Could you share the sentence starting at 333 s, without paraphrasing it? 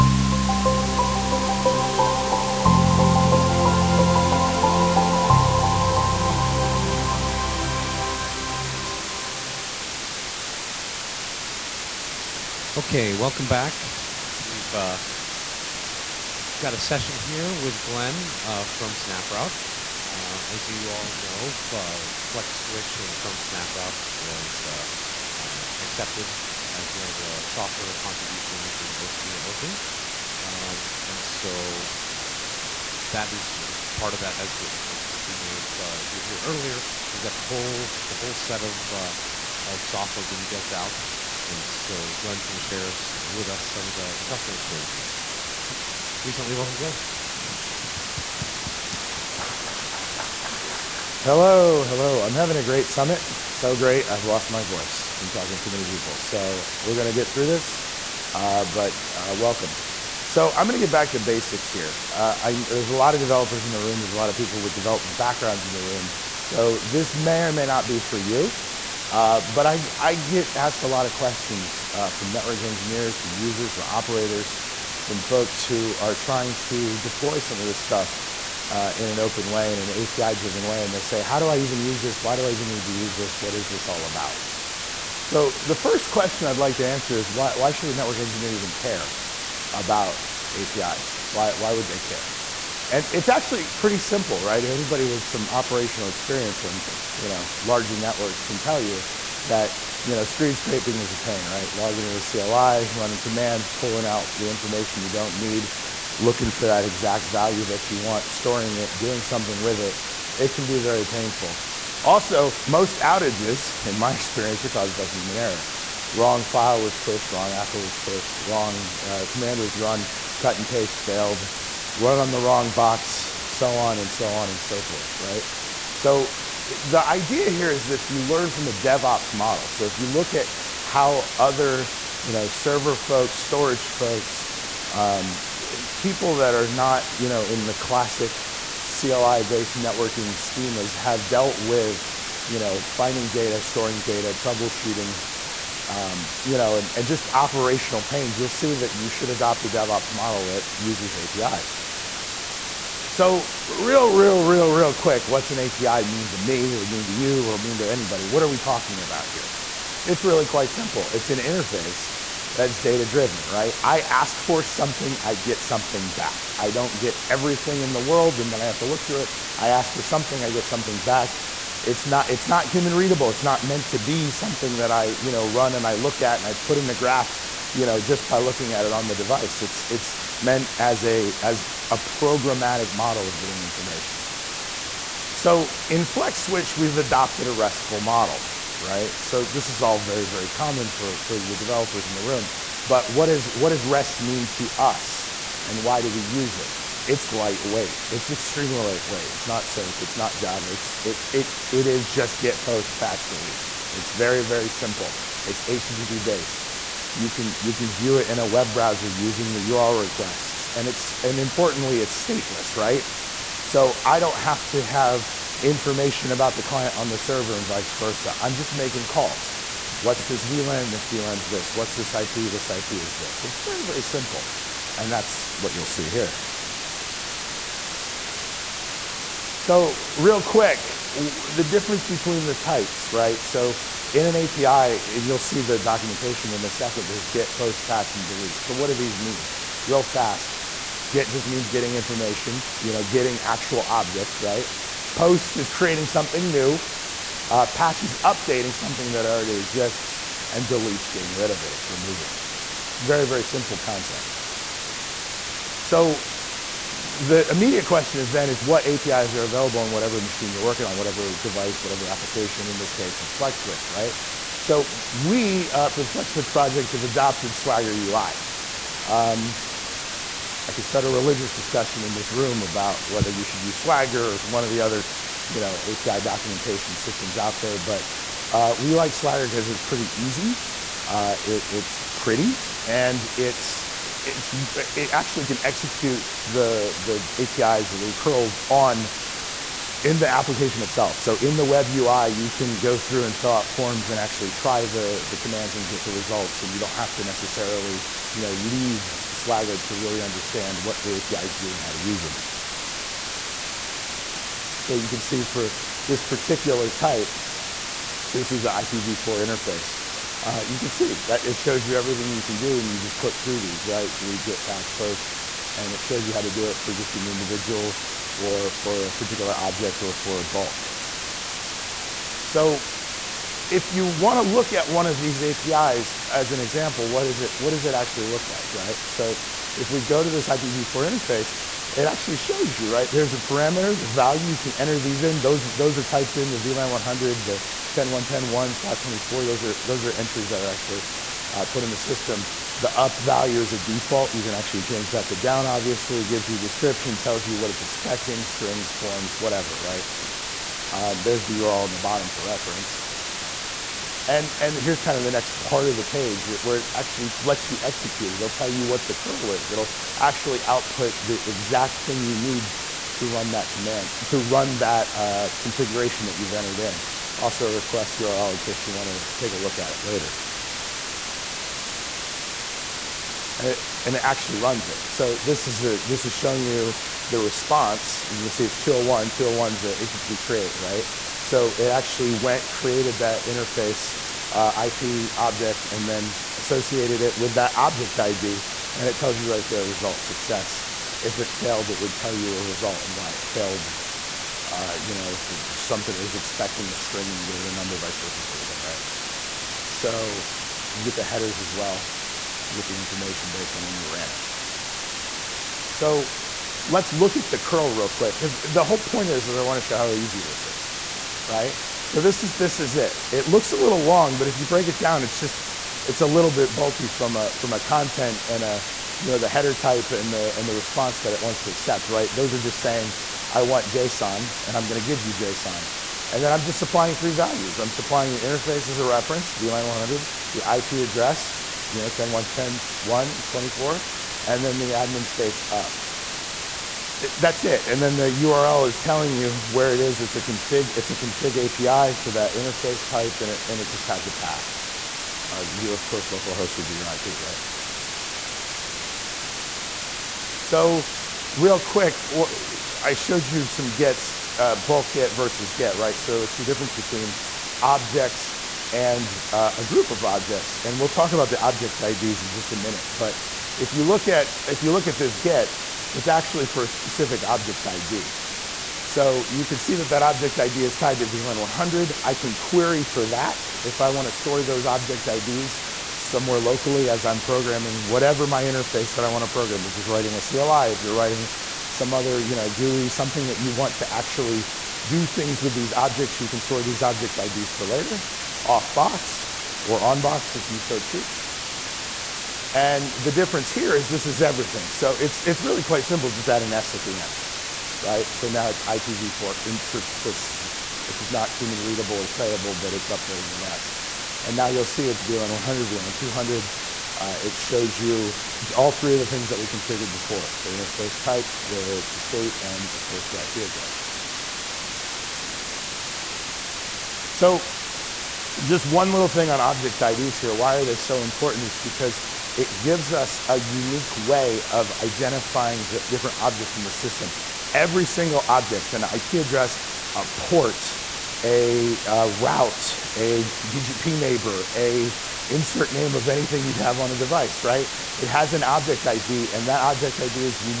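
There's a parameter, the value, you can enter these in.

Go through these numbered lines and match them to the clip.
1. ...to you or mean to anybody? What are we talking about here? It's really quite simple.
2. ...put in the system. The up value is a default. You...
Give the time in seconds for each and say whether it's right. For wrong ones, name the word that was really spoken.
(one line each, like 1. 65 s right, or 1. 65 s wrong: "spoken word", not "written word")
1. 157 s right
2. 341 s right.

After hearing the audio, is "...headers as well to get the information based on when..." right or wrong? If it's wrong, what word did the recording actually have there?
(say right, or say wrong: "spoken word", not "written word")
right.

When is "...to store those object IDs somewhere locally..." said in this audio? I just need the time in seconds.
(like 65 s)
474 s.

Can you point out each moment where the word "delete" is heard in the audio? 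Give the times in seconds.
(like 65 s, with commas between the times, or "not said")
203 s, 238 s, 250 s, 314 s.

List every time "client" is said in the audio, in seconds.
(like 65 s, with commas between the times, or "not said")
216 s.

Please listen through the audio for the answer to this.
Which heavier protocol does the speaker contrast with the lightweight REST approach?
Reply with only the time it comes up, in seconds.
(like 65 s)
199 s.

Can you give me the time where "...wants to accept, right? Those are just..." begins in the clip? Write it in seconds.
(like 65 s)
421 s.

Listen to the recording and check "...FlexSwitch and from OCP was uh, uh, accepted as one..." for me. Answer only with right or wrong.
wrong.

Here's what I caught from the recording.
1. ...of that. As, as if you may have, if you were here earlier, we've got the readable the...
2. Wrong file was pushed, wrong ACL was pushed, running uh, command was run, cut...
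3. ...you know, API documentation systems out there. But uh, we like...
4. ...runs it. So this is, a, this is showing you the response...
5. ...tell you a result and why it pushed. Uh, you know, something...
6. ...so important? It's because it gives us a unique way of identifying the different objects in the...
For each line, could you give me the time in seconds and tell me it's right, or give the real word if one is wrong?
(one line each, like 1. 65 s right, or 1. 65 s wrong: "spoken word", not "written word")
1. 34 s wrong: "whole", not "readable"
2. 116 s wrong: "wrong", not "running"
3. 275 s right
4. 374 s right
5. 392 s wrong: "failed", not "pushed"
6. 520 s right.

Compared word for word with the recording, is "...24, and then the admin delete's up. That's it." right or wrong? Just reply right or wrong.
wrong.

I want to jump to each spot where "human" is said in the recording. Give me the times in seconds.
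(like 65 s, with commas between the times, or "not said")
115 s, 172 s, 501 s.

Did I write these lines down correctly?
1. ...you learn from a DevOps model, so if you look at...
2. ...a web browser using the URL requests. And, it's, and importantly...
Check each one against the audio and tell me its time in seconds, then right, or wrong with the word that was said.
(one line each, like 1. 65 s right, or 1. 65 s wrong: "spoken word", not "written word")
1. 128 s right
2. 208 s right.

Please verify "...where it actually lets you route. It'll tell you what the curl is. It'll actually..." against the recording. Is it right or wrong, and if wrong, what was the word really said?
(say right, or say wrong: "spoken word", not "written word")
wrong: "execute", not "route".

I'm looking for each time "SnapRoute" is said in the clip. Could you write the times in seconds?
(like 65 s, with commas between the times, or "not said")
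18 s, 23 s.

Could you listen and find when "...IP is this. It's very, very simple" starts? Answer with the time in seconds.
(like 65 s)
222 s.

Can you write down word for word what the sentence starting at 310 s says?
Uh, you can see that it shows you everything you can do, and you just click through these, right?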